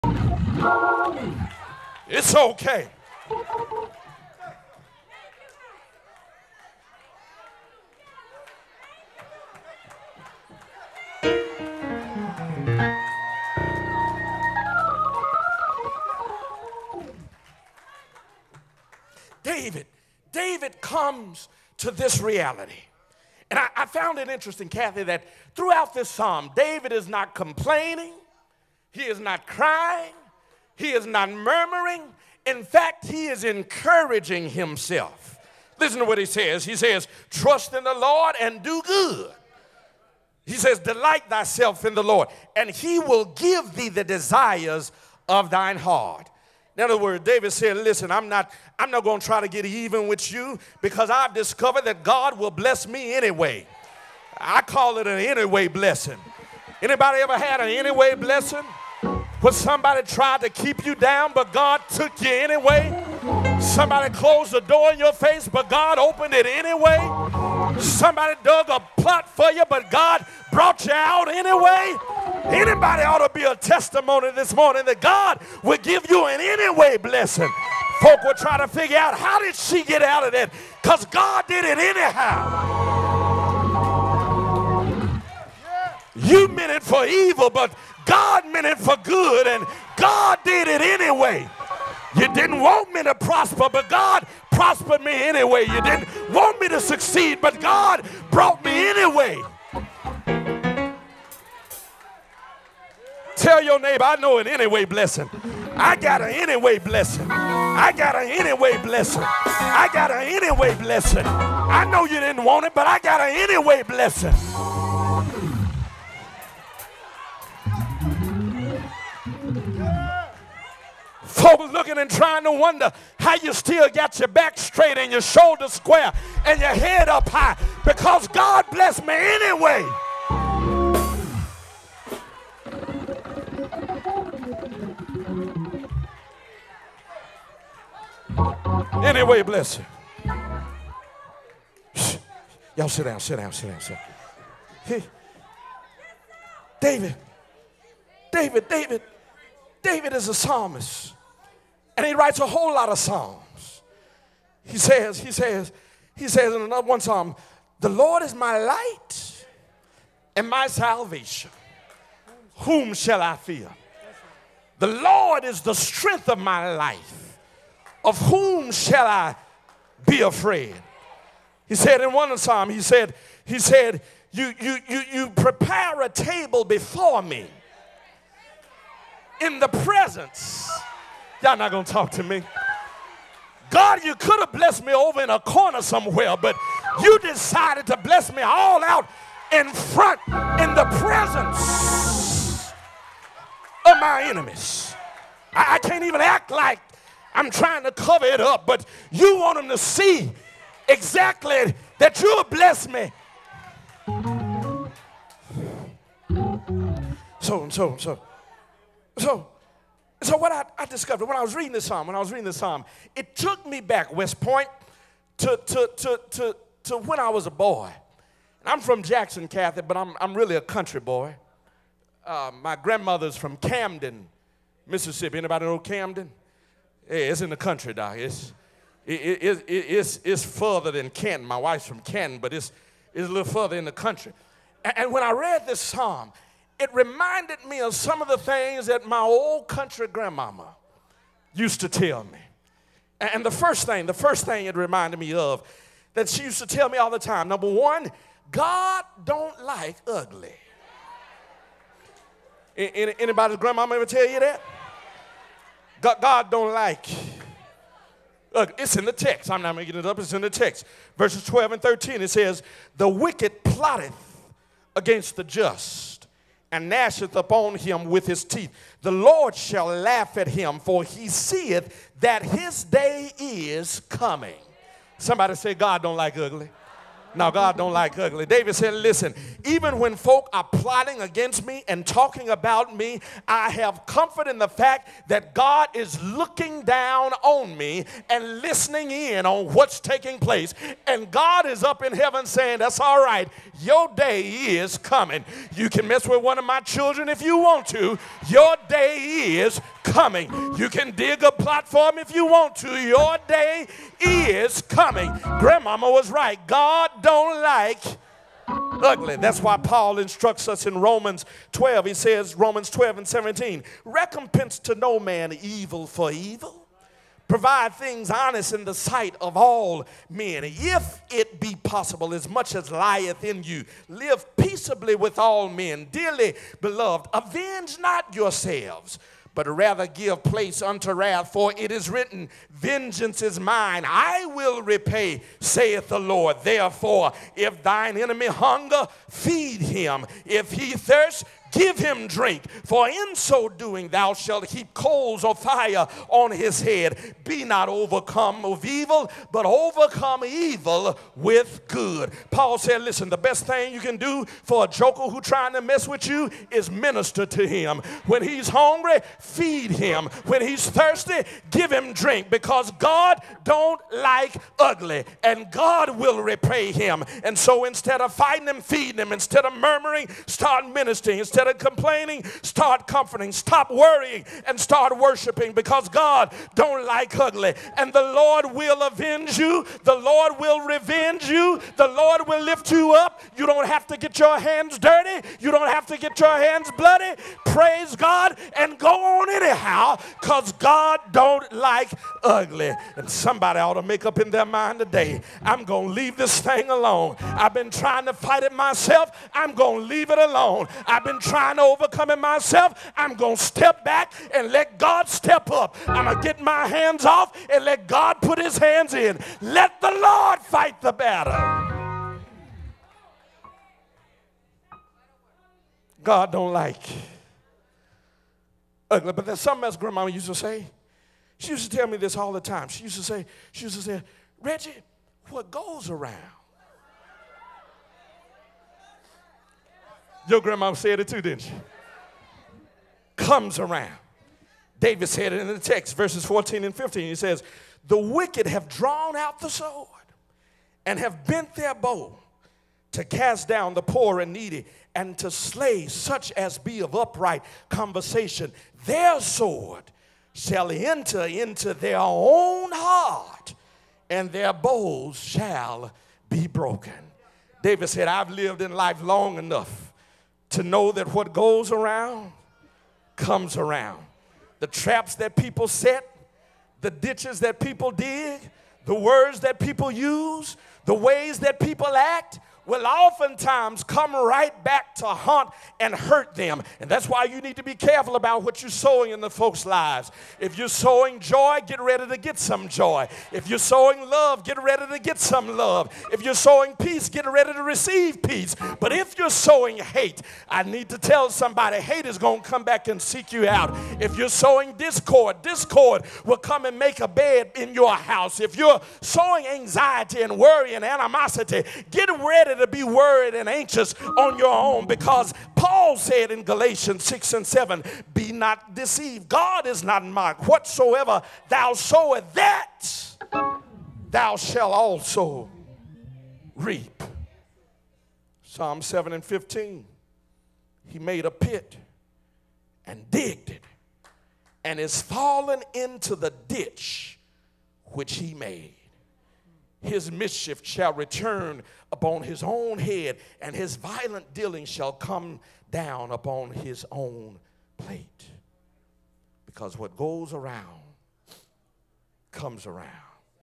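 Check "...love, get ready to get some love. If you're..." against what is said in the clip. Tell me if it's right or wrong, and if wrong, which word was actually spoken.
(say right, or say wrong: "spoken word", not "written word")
right.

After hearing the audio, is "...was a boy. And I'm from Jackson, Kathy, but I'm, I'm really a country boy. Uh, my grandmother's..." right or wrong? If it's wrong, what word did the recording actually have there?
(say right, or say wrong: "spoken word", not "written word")
right.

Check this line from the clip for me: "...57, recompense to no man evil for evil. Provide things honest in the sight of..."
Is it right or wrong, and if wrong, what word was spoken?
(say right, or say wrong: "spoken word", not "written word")
wrong: "17", not "57".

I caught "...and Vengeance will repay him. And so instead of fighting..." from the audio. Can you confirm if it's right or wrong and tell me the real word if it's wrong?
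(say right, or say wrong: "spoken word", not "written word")
wrong: "God", not "Vengeance".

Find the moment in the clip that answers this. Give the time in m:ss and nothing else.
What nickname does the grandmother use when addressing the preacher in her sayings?
7:04.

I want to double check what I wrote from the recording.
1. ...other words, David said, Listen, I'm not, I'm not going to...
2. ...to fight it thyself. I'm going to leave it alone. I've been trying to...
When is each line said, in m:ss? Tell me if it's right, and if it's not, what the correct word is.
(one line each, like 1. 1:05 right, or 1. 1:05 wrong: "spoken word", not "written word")
1. 0:46 right
2. 6:38 wrong: "myself", not "thyself".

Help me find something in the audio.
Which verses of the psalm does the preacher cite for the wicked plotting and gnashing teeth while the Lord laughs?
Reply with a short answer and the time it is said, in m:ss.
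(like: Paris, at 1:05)
12 and 13, at 4:21.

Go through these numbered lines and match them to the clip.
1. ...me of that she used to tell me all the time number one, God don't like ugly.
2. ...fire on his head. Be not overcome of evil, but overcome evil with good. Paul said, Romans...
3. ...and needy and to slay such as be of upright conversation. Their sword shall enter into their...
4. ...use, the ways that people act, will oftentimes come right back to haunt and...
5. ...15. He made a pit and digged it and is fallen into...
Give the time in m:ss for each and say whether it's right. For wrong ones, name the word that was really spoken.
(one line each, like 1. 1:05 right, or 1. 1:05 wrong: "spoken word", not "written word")
1. 4:05 right
2. 5:45 wrong: "Listen", not "Romans"
3. 7:24 right
4. 7:50 right
5. 8:39 right.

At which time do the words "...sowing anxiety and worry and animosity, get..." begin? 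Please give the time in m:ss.
8:19.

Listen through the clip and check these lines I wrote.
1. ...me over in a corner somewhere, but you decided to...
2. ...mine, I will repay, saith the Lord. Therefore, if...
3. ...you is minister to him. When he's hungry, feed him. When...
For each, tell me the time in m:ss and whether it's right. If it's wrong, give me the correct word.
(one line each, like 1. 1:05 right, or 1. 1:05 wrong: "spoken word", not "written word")
1. 3:04 right
2. 5:33 right
3. 5:56 right.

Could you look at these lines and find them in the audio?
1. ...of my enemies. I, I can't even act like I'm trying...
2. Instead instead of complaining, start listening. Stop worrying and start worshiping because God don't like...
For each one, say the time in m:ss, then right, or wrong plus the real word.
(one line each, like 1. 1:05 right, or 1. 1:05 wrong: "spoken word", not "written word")
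1. 3:13 right
2. 6:11 wrong: "comforting", not "listening".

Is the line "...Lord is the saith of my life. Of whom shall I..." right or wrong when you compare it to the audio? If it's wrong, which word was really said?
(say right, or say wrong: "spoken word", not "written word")
wrong: "strength", not "saith".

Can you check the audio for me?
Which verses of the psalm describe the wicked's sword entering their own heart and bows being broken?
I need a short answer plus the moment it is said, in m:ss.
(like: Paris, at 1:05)
14 and 15, at 7:16.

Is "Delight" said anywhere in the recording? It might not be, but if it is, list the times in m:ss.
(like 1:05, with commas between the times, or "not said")
0:40.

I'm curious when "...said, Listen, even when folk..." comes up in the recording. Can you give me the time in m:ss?
4:38.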